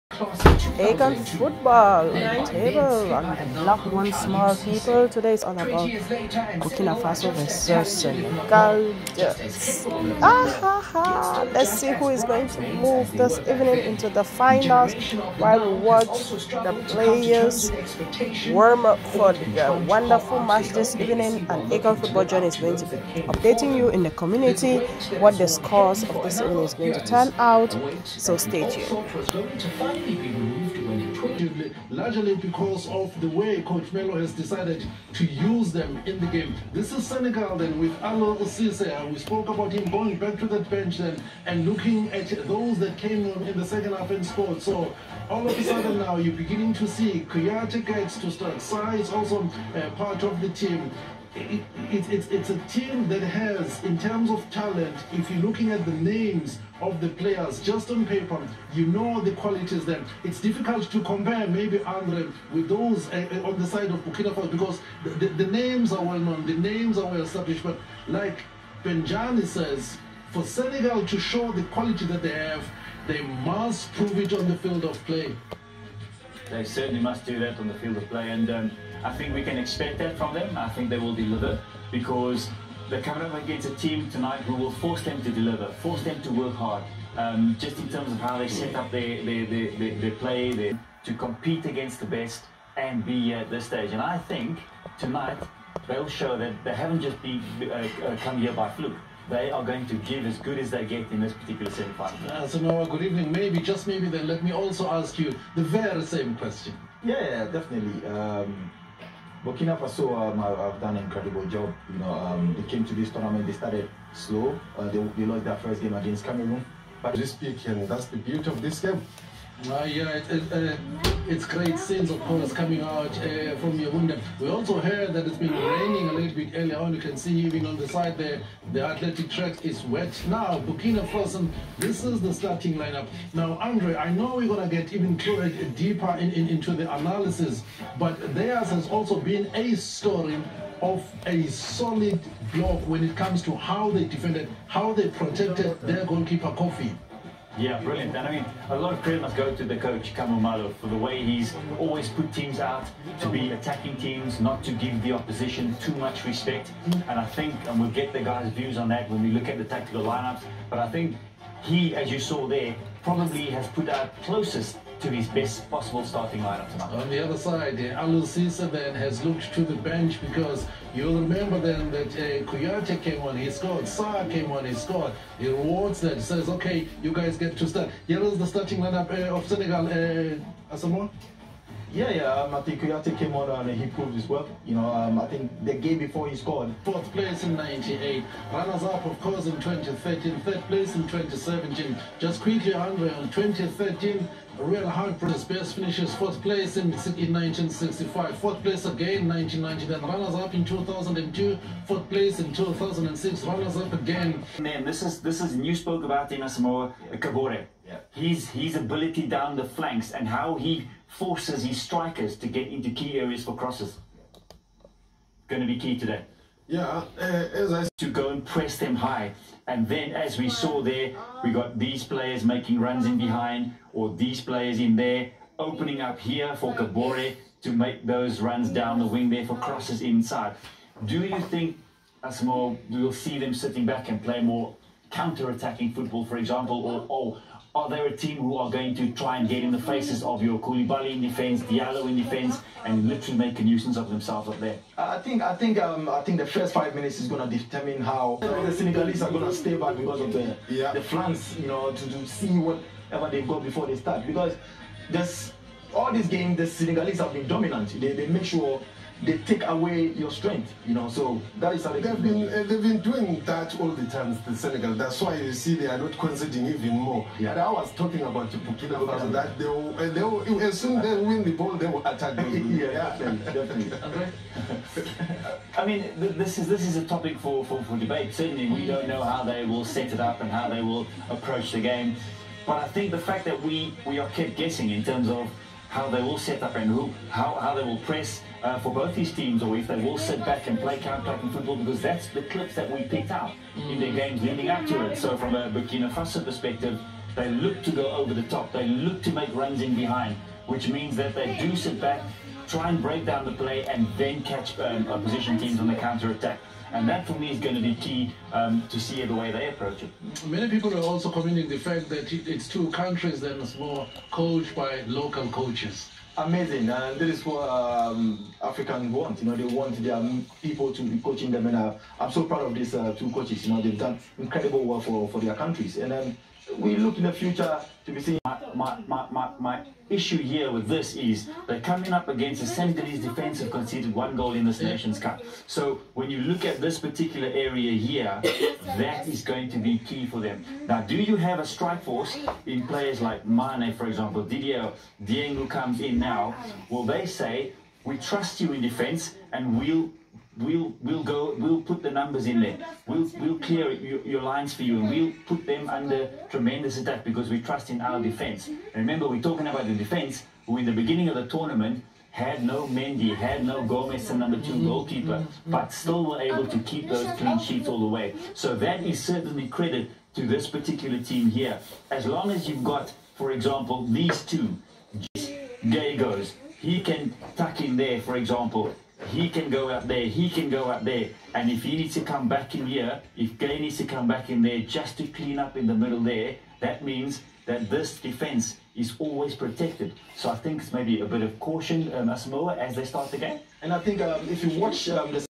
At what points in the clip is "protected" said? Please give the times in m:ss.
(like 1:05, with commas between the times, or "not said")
2:25, 6:29.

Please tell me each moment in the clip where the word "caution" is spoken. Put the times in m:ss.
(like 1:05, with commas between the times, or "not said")
6:31.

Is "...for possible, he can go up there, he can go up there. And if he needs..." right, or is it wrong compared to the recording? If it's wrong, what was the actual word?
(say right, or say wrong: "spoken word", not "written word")
wrong: "example", not "possible".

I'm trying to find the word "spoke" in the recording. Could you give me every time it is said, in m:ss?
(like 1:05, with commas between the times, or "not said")
0:39, 3:25.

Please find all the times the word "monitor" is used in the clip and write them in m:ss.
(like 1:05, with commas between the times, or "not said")
not said.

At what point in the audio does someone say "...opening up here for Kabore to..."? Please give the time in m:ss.
3:45.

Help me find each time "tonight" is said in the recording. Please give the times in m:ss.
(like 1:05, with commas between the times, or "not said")
1:24, 1:34, 2:46.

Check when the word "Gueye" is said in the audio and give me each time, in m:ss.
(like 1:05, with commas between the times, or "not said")
6:15, 6:23.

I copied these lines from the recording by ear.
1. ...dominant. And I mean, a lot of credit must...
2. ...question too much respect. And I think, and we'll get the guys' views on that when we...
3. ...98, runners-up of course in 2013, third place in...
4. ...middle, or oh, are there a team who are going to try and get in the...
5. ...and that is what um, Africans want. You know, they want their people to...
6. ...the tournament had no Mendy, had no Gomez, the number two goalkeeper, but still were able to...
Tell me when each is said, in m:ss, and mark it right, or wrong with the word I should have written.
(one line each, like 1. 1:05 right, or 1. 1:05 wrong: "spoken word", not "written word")
1. 2:27 wrong: "brilliant", not "dominant"
2. 2:35 wrong: "opposition", not "question"
3. 3:07 right
4. 3:56 wrong: "example", not "middle"
5. 5:16 right
6. 6:01 right.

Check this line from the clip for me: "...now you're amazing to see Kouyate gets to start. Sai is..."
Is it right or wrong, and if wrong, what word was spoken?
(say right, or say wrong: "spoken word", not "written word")
wrong: "beginning", not "amazing".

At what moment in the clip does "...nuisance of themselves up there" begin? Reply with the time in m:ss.
4:03.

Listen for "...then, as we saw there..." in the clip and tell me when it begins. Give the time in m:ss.
3:39.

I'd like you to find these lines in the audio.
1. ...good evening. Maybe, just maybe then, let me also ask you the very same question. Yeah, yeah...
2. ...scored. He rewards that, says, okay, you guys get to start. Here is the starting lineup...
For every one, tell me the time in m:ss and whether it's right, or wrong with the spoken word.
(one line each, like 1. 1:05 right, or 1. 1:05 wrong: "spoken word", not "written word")
1. 1:42 right
2. 2:54 right.